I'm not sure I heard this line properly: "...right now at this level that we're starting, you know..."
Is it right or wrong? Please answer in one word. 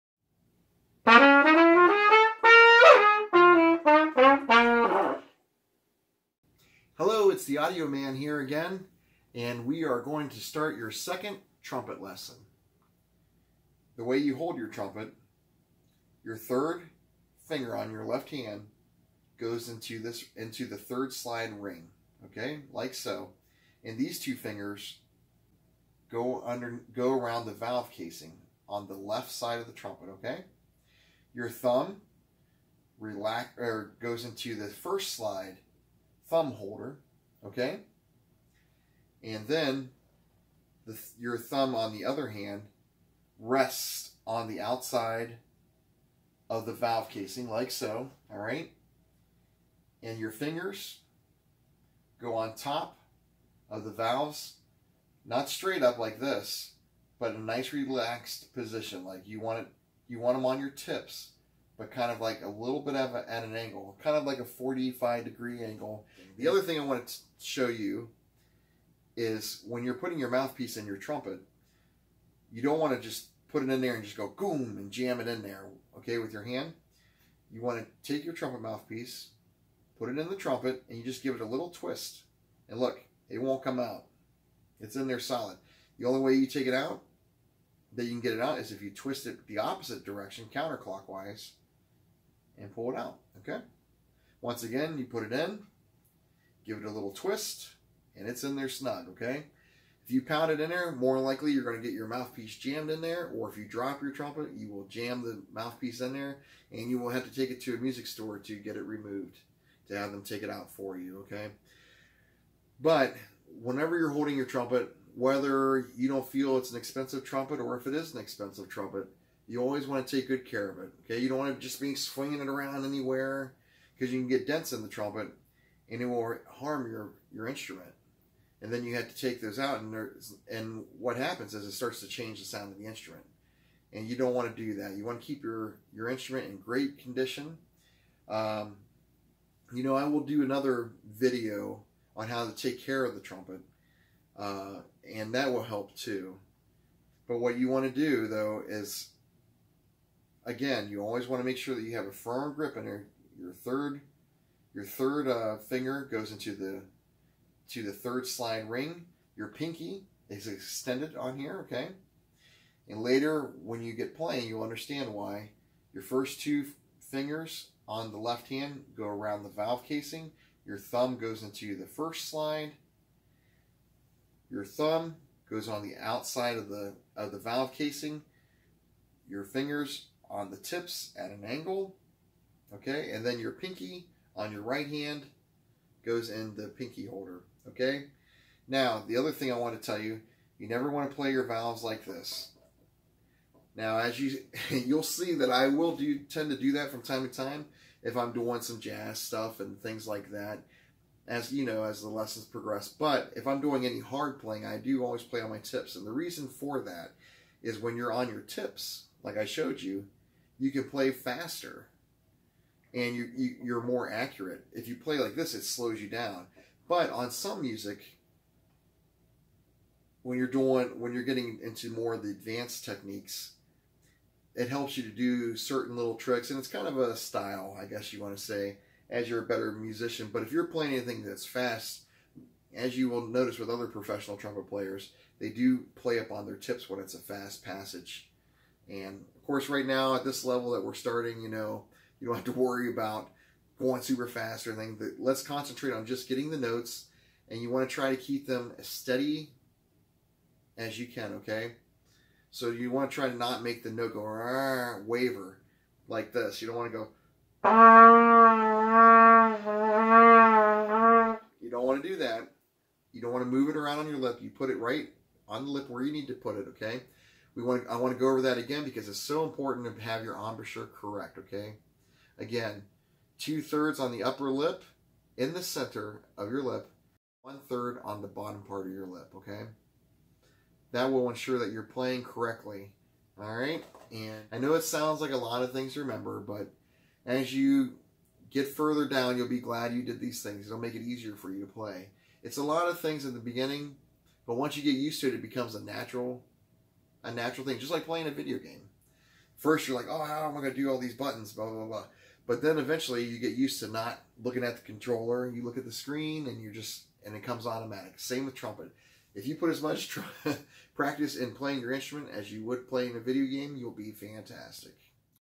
right.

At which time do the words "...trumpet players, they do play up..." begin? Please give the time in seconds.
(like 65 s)
234 s.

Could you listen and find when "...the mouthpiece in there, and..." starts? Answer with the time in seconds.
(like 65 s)
105 s.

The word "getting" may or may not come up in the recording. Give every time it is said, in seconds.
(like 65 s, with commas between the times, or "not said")
221 s, 246 s.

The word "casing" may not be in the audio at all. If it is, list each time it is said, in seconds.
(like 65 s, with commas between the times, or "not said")
27 s, 47 s, 169 s, 177 s.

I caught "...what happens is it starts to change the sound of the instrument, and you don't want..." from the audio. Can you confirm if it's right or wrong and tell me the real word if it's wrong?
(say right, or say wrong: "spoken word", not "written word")
right.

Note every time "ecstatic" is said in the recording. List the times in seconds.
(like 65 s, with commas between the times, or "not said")
not said.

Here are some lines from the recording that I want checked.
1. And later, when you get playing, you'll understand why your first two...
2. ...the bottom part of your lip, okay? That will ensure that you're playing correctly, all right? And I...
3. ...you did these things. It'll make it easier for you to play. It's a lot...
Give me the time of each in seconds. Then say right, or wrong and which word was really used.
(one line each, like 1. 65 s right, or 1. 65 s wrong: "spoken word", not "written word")
1. 162 s right
2. 278 s right
3. 289 s right.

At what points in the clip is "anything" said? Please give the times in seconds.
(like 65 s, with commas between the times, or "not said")
230 s, 244 s.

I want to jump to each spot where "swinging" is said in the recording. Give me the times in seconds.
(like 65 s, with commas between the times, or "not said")
121 s.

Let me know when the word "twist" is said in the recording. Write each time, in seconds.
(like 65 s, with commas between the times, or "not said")
81 s, 88 s, 97 s.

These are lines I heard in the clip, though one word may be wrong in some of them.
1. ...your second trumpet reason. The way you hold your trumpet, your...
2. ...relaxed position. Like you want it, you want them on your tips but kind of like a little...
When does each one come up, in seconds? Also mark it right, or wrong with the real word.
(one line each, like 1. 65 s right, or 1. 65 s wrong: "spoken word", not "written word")
1. 10 s wrong: "lesson", not "reason"
2. 57 s right.